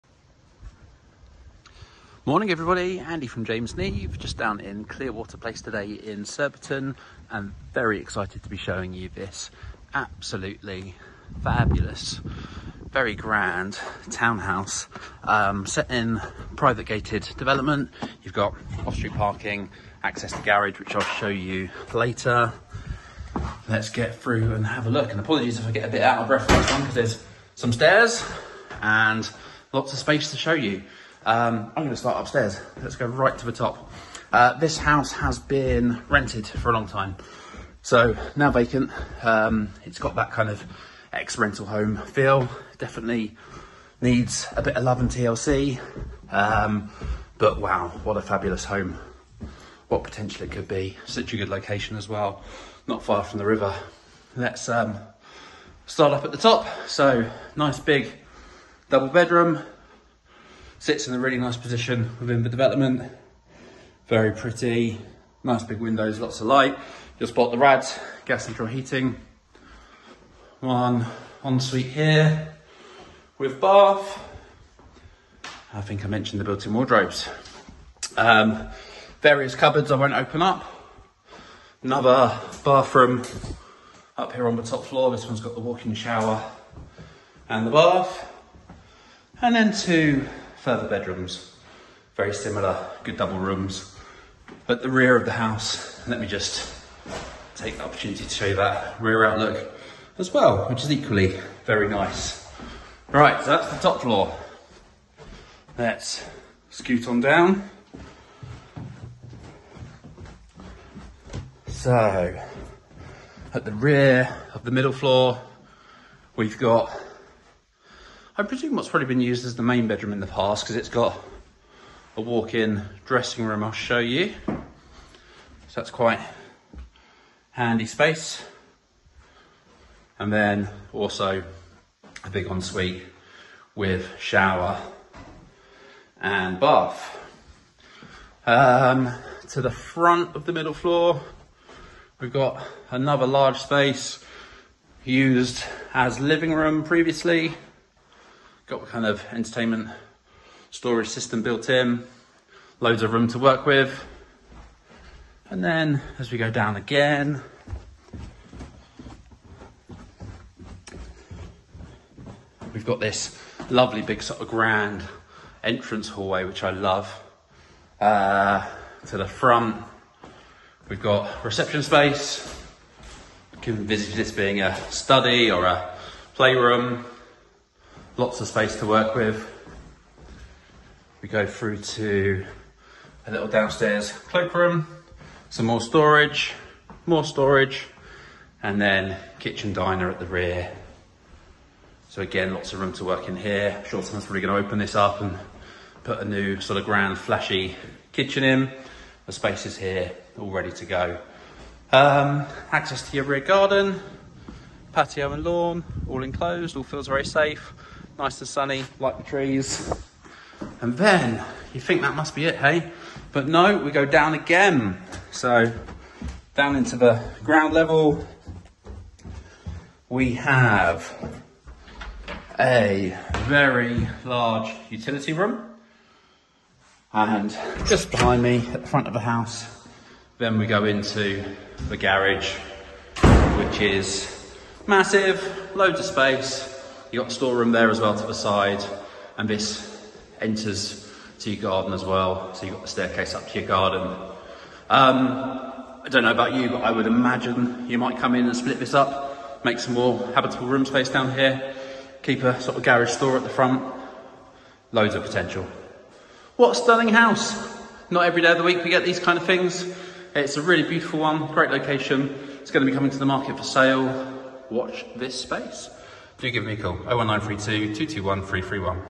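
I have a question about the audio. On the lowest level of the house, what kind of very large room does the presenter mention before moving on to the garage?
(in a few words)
Utility room.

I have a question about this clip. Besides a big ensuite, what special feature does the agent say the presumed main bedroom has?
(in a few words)
Walk-in dressing room.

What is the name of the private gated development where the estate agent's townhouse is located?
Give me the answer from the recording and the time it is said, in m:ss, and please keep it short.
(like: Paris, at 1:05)
Clearwater Place, at 0:04.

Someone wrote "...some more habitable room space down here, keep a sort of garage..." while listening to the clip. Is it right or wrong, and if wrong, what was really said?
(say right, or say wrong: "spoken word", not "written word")
right.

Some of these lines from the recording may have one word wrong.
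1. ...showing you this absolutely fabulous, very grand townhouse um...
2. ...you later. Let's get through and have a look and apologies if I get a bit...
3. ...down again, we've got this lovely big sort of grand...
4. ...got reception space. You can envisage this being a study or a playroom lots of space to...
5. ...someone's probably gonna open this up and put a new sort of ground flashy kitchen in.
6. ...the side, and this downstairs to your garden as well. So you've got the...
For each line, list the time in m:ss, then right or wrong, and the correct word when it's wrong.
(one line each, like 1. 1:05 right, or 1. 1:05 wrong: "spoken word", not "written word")
1. 0:08 right
2. 0:21 right
3. 2:36 right
4. 2:51 right
5. 3:14 wrong: "grand", not "ground"
6. 3:58 wrong: "enters", not "downstairs".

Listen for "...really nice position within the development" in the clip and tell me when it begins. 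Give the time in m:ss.
1:01.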